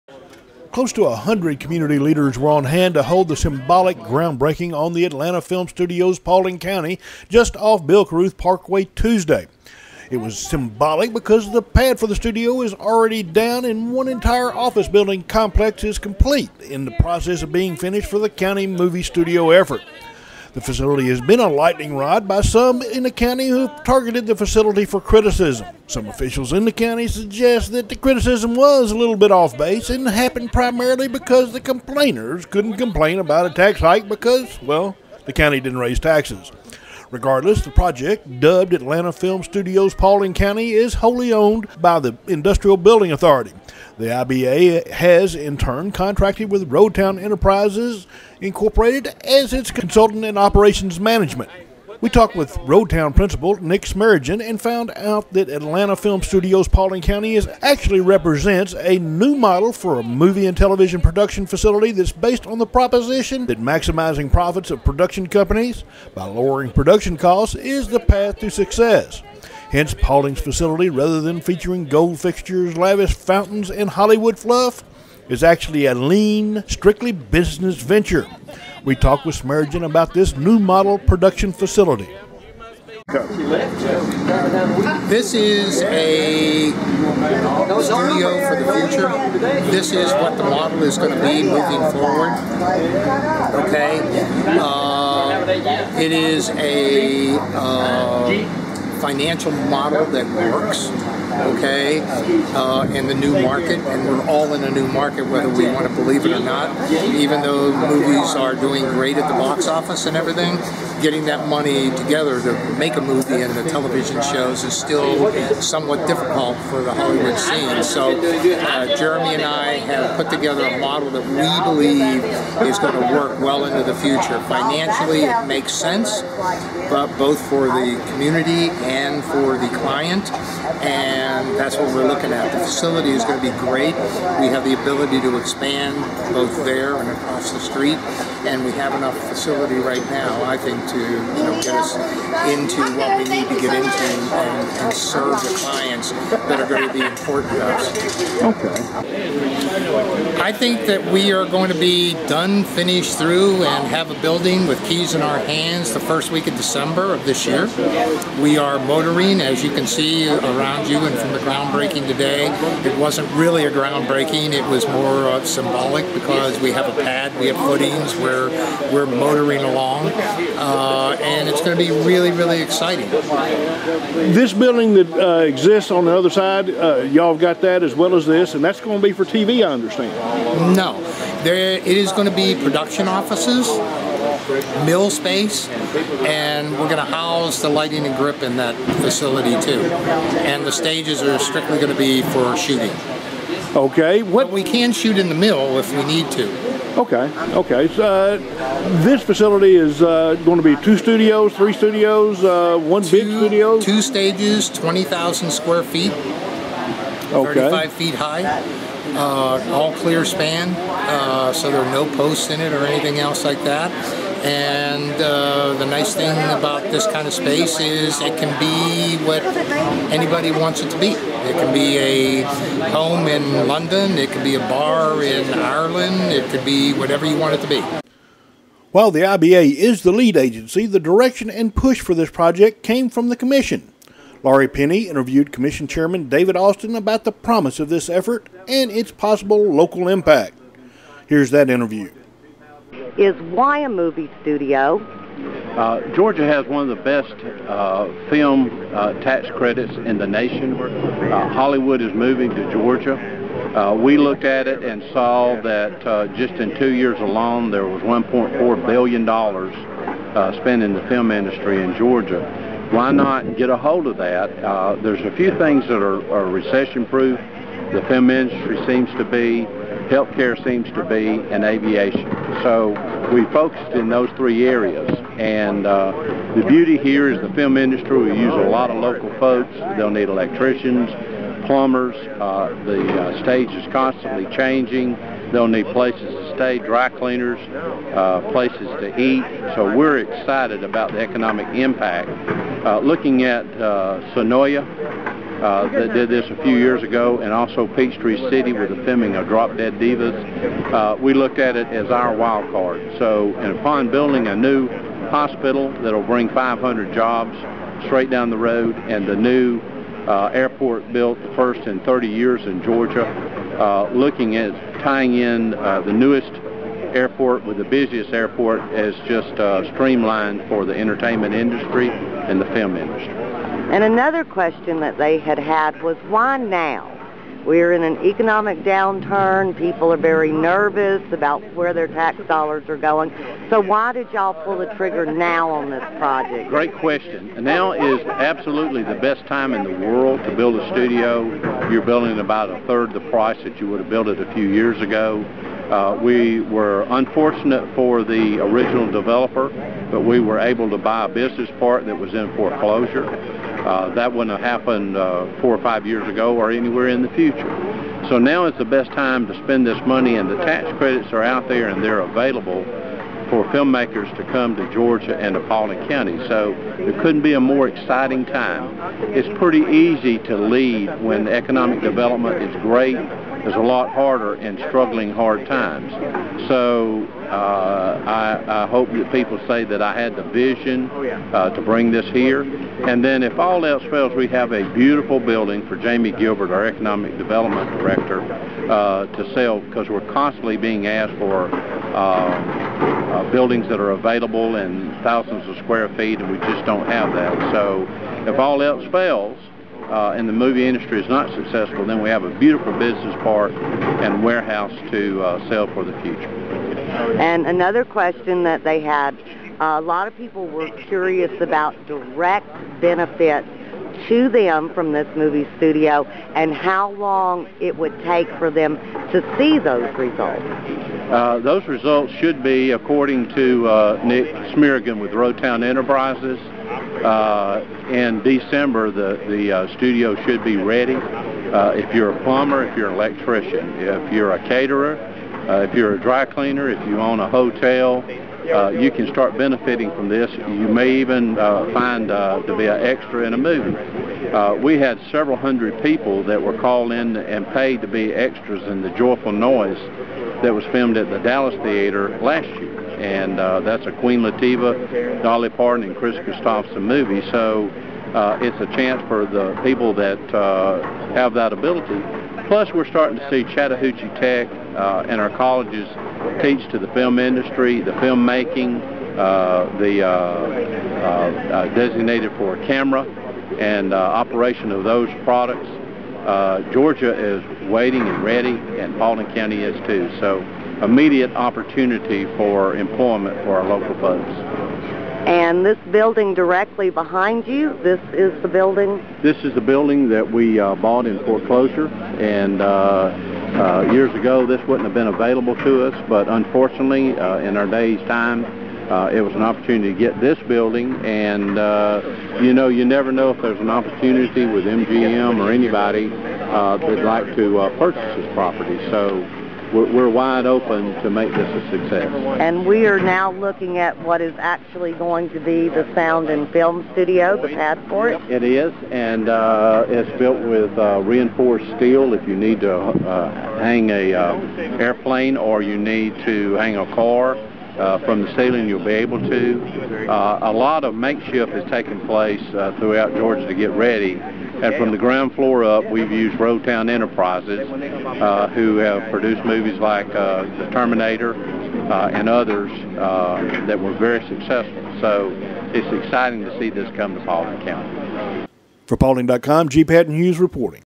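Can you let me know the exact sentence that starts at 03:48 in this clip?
While the IBA is the lead agency, the direction and push for this project came from the Commission.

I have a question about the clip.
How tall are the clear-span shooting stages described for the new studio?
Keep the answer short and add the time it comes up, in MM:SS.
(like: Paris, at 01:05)
35 feet, at 03:27.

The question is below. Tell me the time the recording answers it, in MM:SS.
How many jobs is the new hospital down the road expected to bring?
05:06.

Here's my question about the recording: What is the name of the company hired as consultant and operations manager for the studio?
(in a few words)
Roadtown Enterprises Incorporated.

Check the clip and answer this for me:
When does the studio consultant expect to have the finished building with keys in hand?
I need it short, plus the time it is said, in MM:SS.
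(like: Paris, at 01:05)
first week of December, at 02:35.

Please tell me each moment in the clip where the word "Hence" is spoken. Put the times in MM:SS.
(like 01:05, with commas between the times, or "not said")
01:09.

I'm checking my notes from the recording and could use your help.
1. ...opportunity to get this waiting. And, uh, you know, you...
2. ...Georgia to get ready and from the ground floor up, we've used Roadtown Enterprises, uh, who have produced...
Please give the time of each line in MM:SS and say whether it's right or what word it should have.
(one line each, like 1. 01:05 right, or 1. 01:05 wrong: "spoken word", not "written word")
1. 08:19 wrong: "building", not "waiting"
2. 08:53 right.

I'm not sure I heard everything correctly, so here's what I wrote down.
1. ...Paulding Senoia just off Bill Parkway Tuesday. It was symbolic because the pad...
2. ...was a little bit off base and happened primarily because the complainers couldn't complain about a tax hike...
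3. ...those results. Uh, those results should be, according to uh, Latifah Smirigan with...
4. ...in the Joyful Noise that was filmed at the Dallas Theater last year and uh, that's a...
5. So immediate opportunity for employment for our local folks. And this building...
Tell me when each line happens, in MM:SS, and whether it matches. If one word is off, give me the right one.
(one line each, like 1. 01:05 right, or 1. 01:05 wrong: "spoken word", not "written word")
1. 00:06 wrong: "County", not "Senoia"
2. 00:28 right
3. 06:59 wrong: "Nick", not "Latifah"
4. 07:28 right
5. 08:00 right.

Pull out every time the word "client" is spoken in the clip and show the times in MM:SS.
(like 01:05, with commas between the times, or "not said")
02:09, 02:25.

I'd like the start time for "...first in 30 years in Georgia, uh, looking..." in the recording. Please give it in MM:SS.
05:11.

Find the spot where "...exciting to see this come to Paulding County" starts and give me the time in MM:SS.
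09:06.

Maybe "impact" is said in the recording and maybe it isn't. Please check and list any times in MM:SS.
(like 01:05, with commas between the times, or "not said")
04:00, 04:51.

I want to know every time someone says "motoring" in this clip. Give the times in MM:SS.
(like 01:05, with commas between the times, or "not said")
02:38, 02:49.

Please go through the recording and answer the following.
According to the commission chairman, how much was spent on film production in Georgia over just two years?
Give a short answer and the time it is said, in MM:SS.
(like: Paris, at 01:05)
$1.4 billion, at 04:18.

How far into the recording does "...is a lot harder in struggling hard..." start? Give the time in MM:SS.
06:13.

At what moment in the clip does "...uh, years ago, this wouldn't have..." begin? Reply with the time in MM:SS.
08:14.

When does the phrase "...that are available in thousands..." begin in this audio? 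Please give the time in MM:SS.
06:33.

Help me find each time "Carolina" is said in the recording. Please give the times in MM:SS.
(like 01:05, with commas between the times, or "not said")
not said.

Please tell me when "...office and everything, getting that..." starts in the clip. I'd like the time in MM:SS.
01:49.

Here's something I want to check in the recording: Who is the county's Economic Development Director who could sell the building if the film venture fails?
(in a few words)
Jamie Gilbert.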